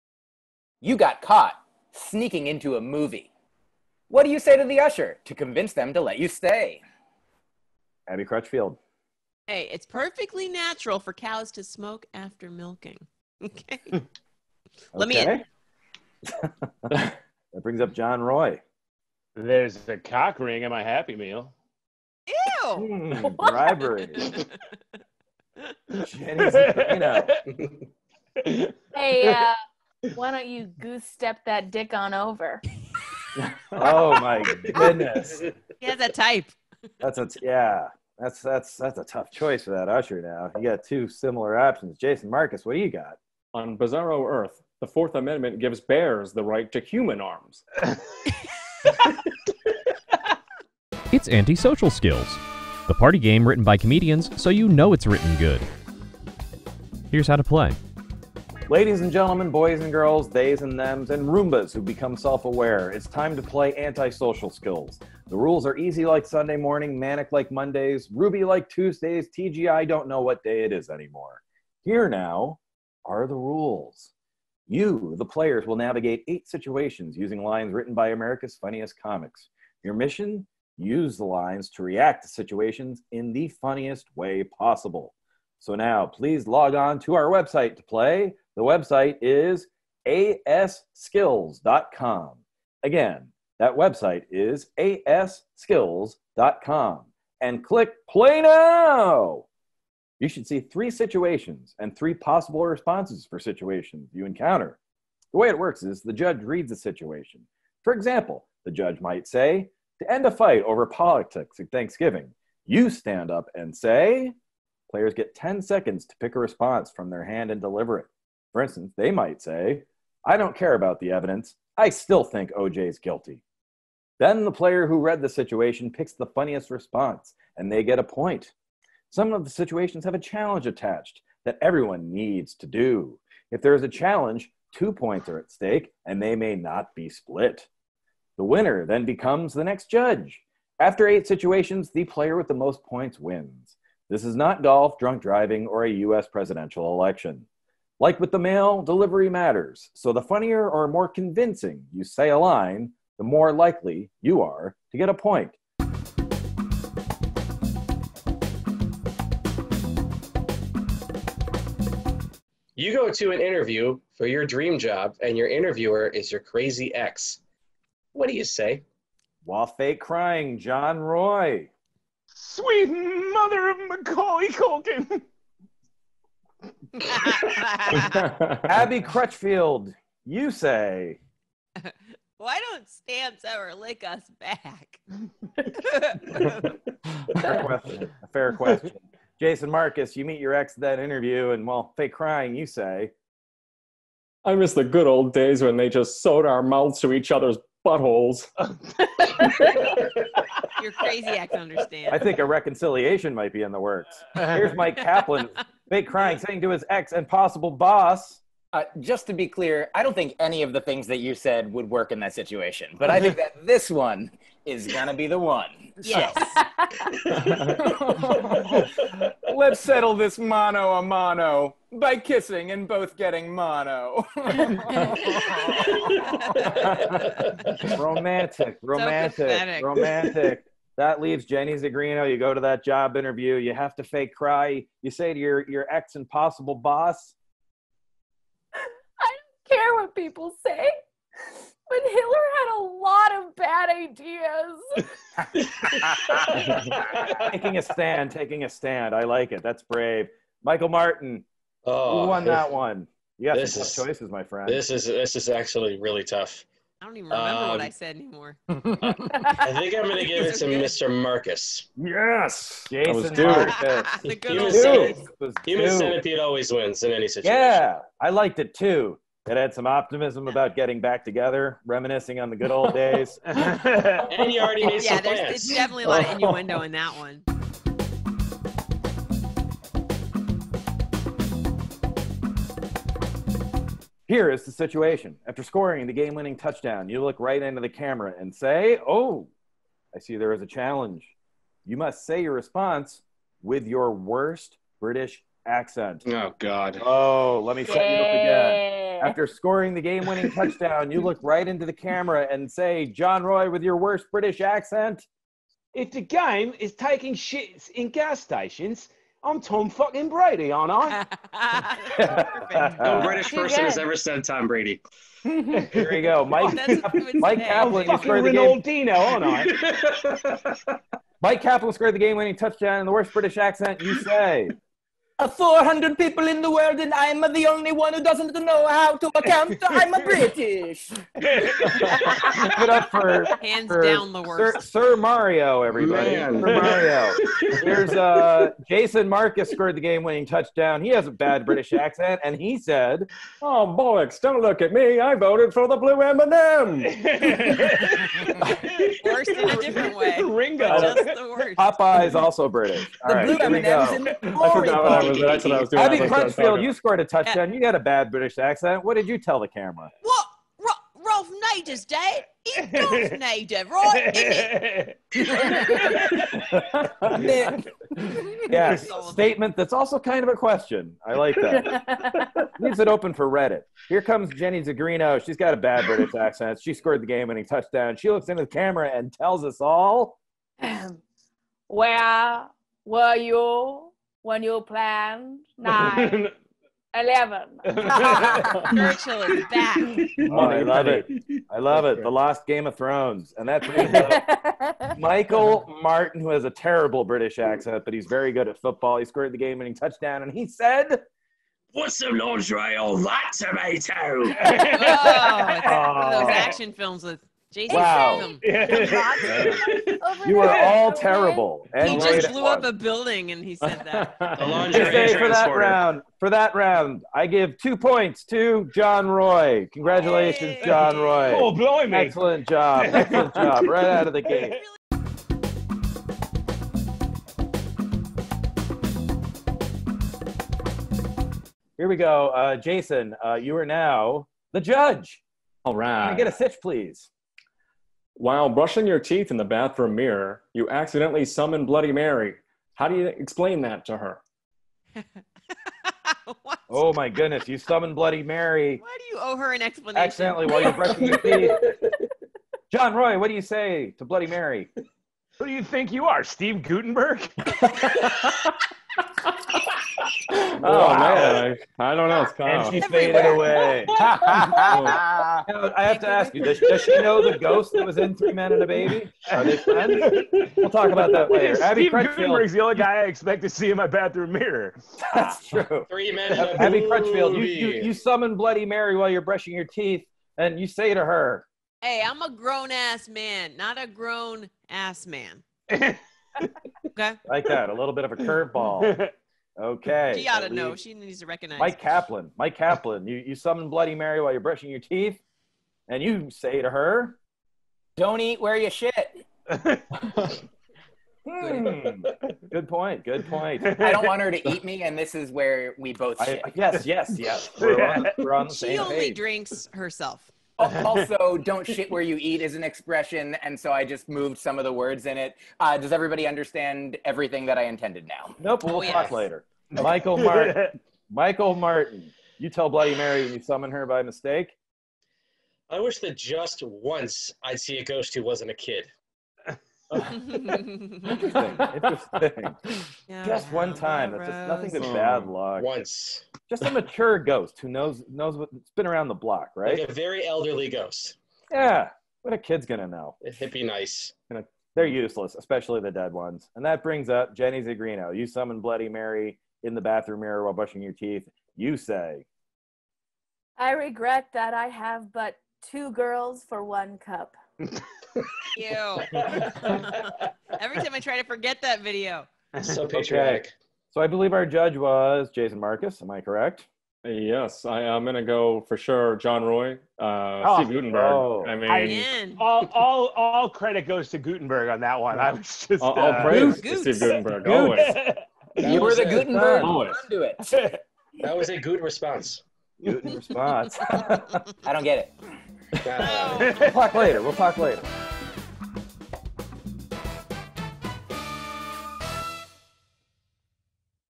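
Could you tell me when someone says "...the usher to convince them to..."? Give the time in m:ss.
0:04.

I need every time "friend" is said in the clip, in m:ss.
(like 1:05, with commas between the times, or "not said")
4:14, 7:49.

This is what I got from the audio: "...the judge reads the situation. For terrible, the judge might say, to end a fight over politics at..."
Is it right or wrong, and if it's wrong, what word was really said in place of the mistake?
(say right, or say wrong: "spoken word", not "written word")
wrong: "example", not "terrible".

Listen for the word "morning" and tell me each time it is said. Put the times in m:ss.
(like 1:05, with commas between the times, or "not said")
1:06.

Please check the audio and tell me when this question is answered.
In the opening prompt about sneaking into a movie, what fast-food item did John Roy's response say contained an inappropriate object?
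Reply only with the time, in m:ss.
0:20.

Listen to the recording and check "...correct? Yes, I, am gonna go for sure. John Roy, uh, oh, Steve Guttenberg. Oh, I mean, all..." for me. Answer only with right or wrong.
right.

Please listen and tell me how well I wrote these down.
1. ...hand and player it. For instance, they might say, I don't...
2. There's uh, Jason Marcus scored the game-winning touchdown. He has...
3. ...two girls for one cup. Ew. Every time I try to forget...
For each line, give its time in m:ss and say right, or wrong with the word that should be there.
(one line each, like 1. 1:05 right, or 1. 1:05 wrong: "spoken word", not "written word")
1. 1:57 wrong: "deliver", not "player"
2. 5:37 right
3. 9:15 right.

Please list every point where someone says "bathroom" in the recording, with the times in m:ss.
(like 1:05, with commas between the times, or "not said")
7:19, 7:54, 9:10.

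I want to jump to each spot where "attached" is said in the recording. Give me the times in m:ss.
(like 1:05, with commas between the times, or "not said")
2:10.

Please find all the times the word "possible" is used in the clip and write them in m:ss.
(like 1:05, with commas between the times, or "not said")
1:24, 1:42, 3:27, 3:56.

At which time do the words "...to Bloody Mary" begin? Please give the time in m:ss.
7:34.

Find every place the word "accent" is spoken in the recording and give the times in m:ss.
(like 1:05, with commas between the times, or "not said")
4:55, 5:04, 5:23, 5:41, 5:58, 6:16, 6:37.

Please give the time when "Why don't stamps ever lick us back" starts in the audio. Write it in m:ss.
3:02.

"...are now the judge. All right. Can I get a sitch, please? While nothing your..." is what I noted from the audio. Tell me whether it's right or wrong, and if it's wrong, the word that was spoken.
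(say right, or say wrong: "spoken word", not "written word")
wrong: "brushing", not "nothing".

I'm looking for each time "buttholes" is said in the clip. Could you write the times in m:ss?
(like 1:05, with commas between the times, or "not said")
3:17.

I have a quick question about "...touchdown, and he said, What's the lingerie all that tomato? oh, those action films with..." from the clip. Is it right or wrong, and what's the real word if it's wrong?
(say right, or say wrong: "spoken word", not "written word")
right.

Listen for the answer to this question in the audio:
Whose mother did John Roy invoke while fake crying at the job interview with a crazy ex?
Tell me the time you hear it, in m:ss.
2:53.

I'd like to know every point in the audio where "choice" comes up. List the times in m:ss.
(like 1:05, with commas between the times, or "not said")
0:39, 4:14.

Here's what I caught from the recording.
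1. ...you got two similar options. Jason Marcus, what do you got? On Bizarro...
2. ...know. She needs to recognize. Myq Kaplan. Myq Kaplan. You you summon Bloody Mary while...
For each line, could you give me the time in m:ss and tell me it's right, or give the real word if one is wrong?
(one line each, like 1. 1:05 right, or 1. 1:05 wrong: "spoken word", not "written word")
1. 0:40 right
2. 8:10 right.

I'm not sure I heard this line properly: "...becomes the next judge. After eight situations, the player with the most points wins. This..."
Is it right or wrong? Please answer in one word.
right.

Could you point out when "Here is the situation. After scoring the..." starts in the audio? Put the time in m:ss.
4:44.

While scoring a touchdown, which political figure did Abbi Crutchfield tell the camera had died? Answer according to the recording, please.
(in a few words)
Ralph Nader.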